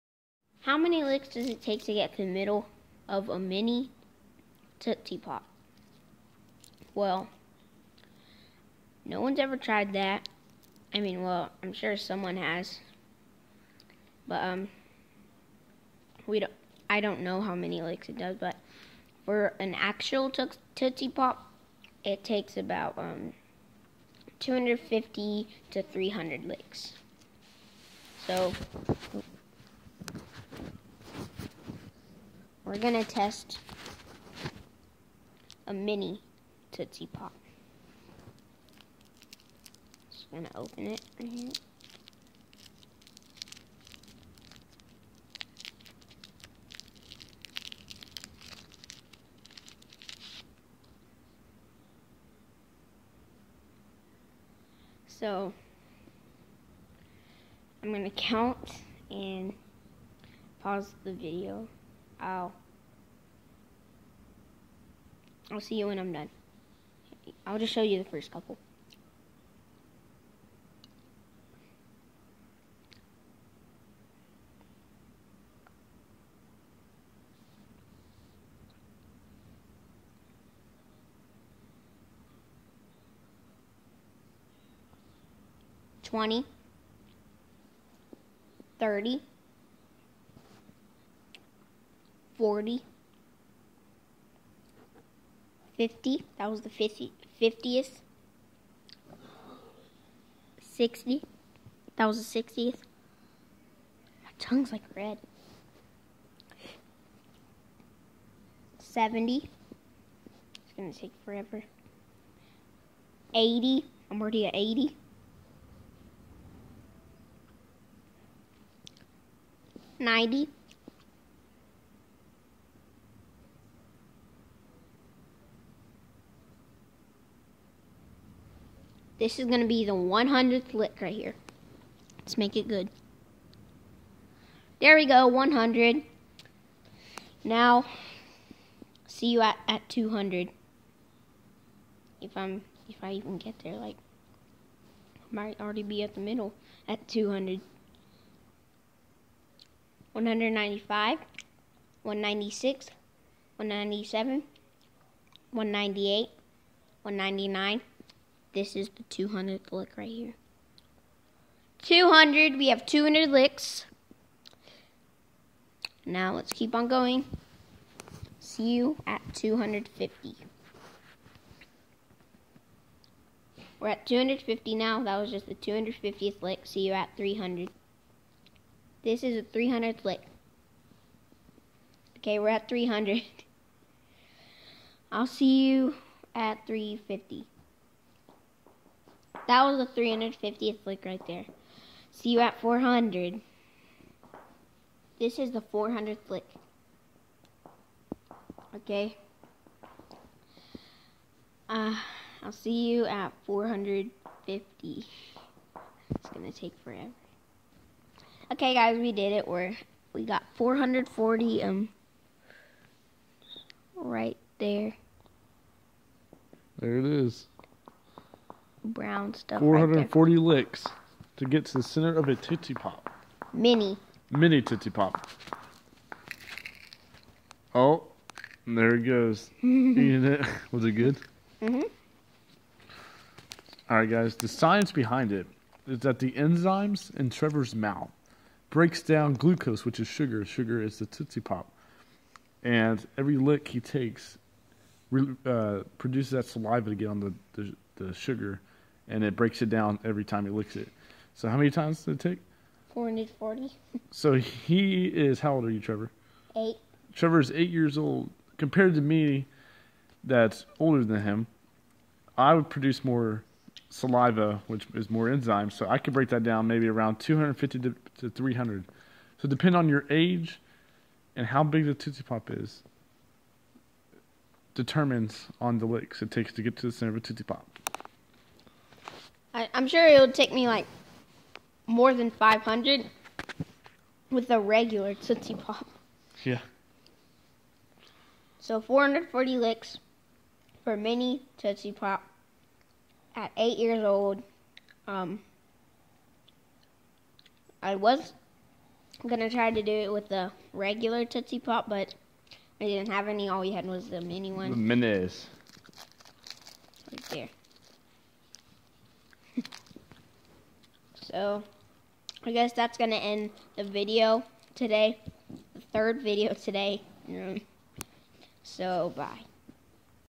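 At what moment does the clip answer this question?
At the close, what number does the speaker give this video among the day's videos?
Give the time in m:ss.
5:15.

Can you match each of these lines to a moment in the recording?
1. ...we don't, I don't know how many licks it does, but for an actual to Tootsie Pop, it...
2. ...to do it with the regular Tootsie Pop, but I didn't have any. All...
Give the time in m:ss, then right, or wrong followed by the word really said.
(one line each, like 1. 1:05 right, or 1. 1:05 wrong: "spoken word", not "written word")
1. 0:16 right
2. 4:59 right.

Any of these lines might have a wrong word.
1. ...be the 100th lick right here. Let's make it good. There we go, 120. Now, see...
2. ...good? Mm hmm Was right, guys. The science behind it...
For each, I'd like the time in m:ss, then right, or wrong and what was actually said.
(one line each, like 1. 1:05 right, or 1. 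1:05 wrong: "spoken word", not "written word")
1. 2:09 wrong: "100", not "120"
2. 3:50 wrong: "All", not "Was".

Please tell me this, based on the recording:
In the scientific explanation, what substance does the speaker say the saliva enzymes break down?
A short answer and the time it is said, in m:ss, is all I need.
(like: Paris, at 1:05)
glucose, at 3:59.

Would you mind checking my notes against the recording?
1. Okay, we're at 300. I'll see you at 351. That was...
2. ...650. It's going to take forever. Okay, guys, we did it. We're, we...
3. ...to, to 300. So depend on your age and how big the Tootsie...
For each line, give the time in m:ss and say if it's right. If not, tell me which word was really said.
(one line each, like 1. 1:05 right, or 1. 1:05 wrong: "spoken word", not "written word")
1. 3:02 wrong: "350", not "351"
2. 3:23 wrong: "450", not "650"
3. 4:27 right.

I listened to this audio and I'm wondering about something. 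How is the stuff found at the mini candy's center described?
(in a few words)
brown stuff.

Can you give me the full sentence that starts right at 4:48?
So 440 licks for mini Tootsie Pop at eight years old.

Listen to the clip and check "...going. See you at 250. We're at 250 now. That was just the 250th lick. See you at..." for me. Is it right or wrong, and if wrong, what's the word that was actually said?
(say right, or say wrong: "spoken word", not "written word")
right.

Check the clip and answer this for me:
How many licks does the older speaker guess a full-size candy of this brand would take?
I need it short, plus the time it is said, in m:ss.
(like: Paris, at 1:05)
more than 500, at 4:41.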